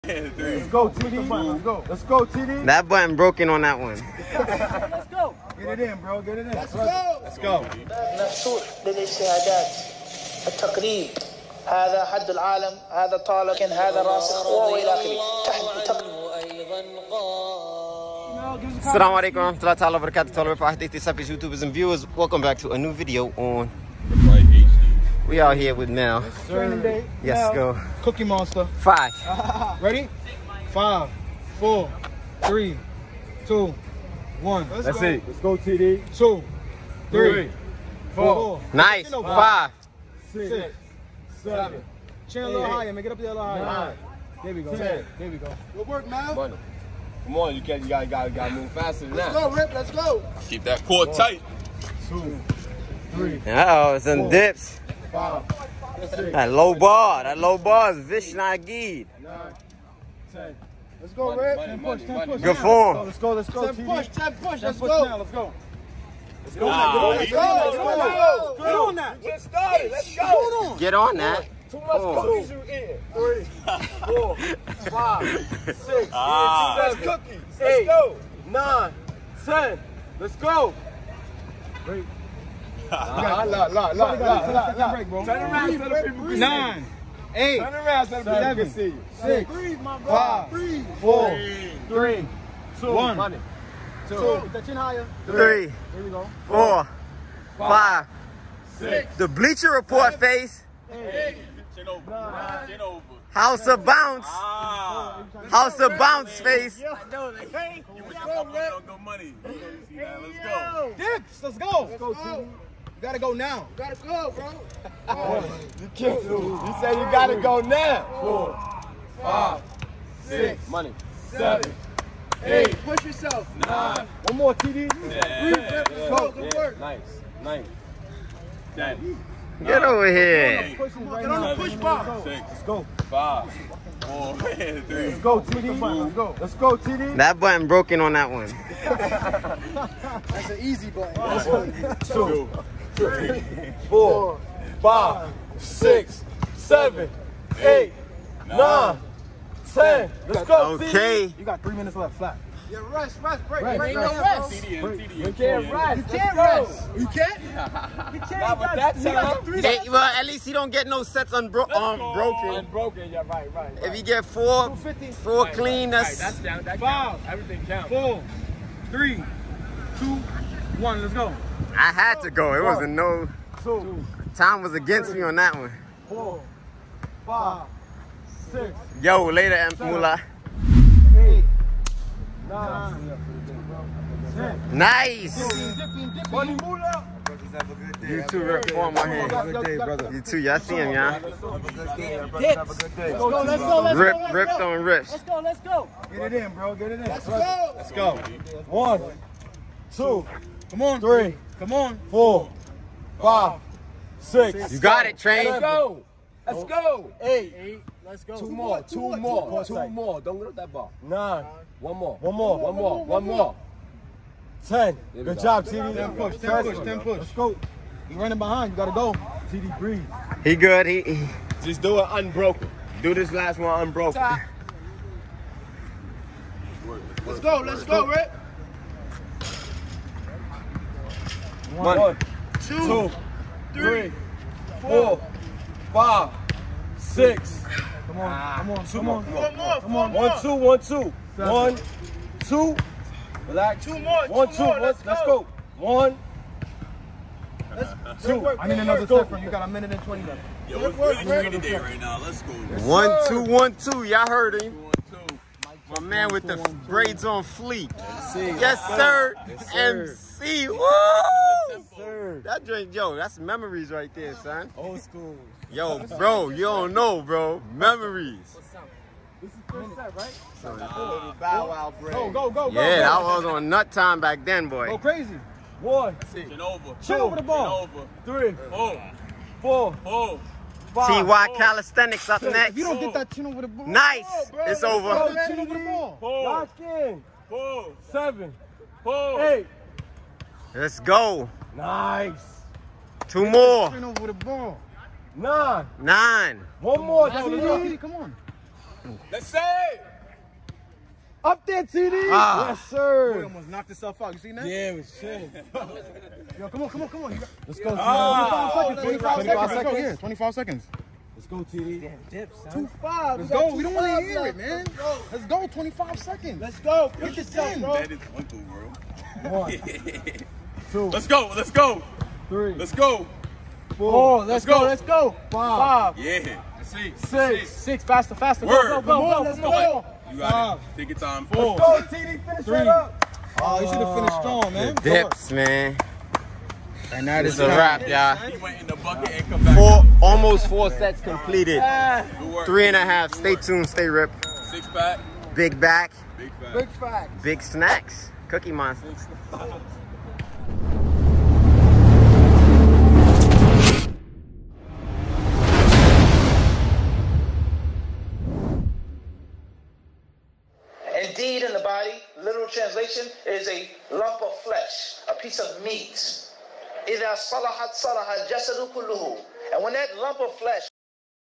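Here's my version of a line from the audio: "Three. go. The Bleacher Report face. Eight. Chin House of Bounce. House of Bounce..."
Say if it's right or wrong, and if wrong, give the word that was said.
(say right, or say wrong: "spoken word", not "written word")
right.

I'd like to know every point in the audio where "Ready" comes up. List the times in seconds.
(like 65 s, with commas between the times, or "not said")
29 s.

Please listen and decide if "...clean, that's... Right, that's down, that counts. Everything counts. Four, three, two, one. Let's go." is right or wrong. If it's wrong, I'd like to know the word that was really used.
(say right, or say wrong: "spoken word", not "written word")
right.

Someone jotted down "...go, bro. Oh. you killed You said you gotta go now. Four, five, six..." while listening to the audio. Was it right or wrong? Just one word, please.
right.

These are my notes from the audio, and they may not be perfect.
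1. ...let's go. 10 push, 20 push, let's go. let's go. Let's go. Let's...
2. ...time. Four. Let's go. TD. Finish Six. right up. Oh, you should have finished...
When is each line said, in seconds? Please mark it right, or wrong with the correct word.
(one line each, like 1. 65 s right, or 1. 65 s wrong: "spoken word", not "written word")
1. 63 s wrong: "10", not "20"
2. 331 s wrong: "Three", not "Six".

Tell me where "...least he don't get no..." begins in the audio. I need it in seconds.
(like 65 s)
160 s.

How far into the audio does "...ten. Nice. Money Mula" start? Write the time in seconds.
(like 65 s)
184 s.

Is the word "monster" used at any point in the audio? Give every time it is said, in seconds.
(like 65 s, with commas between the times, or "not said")
28 s, 348 s.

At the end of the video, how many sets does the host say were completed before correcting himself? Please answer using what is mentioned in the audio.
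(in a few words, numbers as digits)
3.5.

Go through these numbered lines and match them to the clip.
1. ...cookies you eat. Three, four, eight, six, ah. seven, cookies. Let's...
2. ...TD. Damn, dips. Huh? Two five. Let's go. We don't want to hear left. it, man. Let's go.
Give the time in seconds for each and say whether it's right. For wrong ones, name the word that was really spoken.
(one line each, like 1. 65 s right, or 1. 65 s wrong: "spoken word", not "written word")
1. 72 s wrong: "five", not "eight"
2. 311 s right.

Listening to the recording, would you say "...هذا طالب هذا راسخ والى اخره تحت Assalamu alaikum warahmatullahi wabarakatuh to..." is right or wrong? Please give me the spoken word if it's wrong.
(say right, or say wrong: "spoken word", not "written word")
right.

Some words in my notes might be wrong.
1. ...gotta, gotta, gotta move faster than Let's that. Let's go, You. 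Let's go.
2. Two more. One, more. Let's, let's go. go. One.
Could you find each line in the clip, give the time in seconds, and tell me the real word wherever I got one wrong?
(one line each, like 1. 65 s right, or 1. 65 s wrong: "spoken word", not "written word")
1. 47 s wrong: "Rip", not "You"
2. 243 s right.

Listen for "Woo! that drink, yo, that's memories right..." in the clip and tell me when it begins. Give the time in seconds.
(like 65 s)
260 s.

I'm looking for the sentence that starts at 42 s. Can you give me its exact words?
Chin a little higher, Make it up there a little higher.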